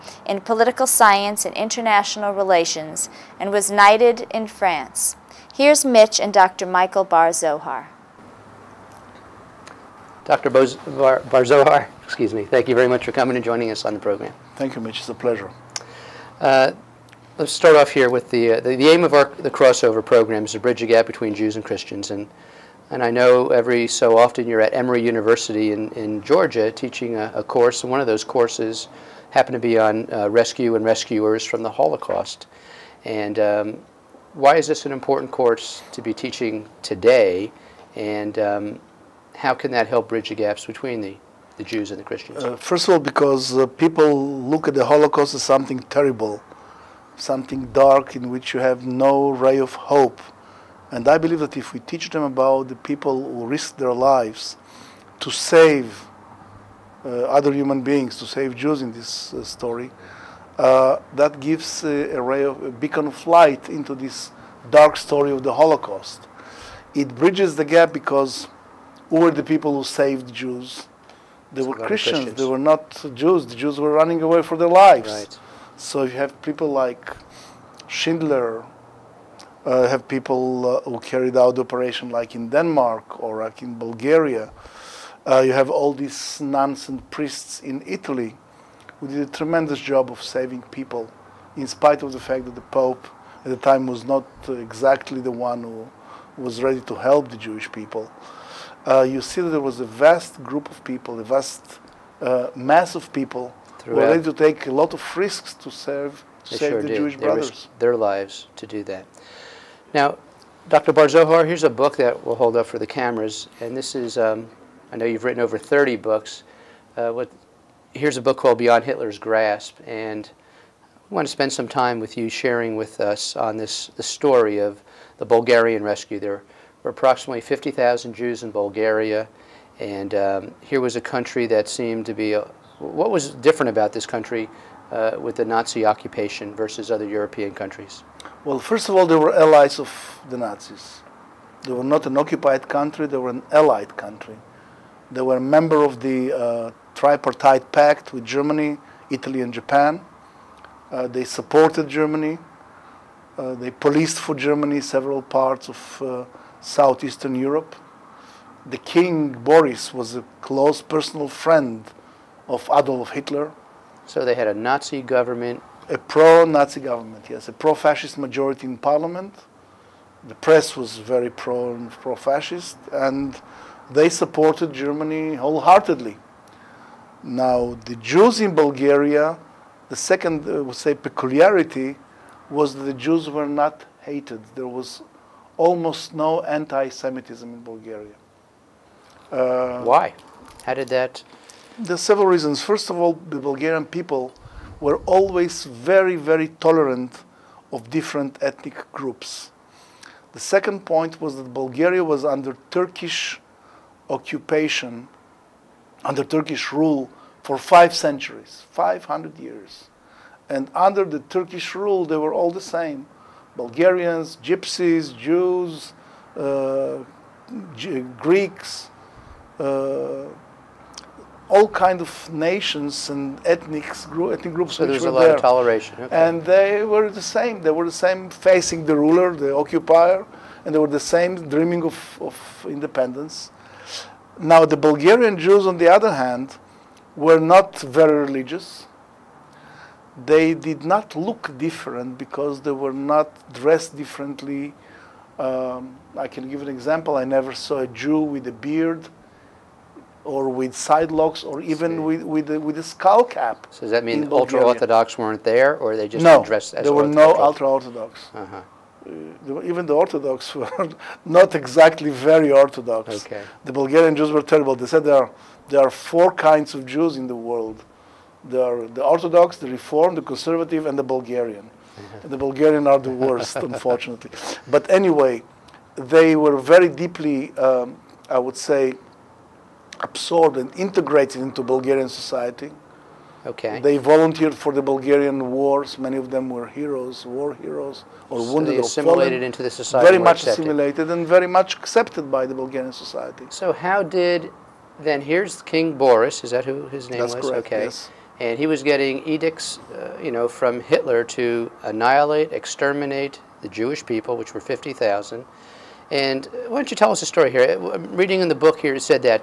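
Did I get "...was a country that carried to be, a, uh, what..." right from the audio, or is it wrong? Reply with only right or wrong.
wrong.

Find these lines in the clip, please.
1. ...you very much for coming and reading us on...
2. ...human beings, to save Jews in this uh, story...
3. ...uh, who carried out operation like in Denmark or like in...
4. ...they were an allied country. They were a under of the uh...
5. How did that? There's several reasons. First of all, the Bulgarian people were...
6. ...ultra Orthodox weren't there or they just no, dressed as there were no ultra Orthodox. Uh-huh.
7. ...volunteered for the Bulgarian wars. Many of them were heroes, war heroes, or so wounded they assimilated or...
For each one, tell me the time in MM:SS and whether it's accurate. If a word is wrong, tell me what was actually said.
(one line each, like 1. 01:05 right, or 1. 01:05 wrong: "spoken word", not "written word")
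1. 00:12 wrong: "joining", not "reading"
2. 00:57 right
3. 01:20 right
4. 02:23 wrong: "member", not "under"
5. 03:10 right
6. 04:14 right
7. 04:43 right.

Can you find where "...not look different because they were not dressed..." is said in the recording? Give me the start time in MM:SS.
04:00.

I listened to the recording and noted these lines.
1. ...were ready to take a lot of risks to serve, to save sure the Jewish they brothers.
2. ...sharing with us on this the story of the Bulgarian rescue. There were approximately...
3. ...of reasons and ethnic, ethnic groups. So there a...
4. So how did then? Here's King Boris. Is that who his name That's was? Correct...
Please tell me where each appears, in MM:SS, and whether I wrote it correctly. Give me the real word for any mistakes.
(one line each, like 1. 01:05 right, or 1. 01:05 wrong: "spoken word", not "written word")
1. 01:43 right
2. 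02:02 right
3. 03:41 wrong: "nations", not "reasons"
4. 04:53 right.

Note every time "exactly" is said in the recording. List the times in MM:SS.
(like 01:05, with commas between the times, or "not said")
01:34, 04:21.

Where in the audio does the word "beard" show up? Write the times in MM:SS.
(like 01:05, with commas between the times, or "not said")
04:08.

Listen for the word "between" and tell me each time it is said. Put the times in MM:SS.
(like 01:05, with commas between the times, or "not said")
00:21, 00:40.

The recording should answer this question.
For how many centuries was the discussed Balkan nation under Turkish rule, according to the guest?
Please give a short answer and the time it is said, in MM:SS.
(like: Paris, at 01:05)
5, at 03:27.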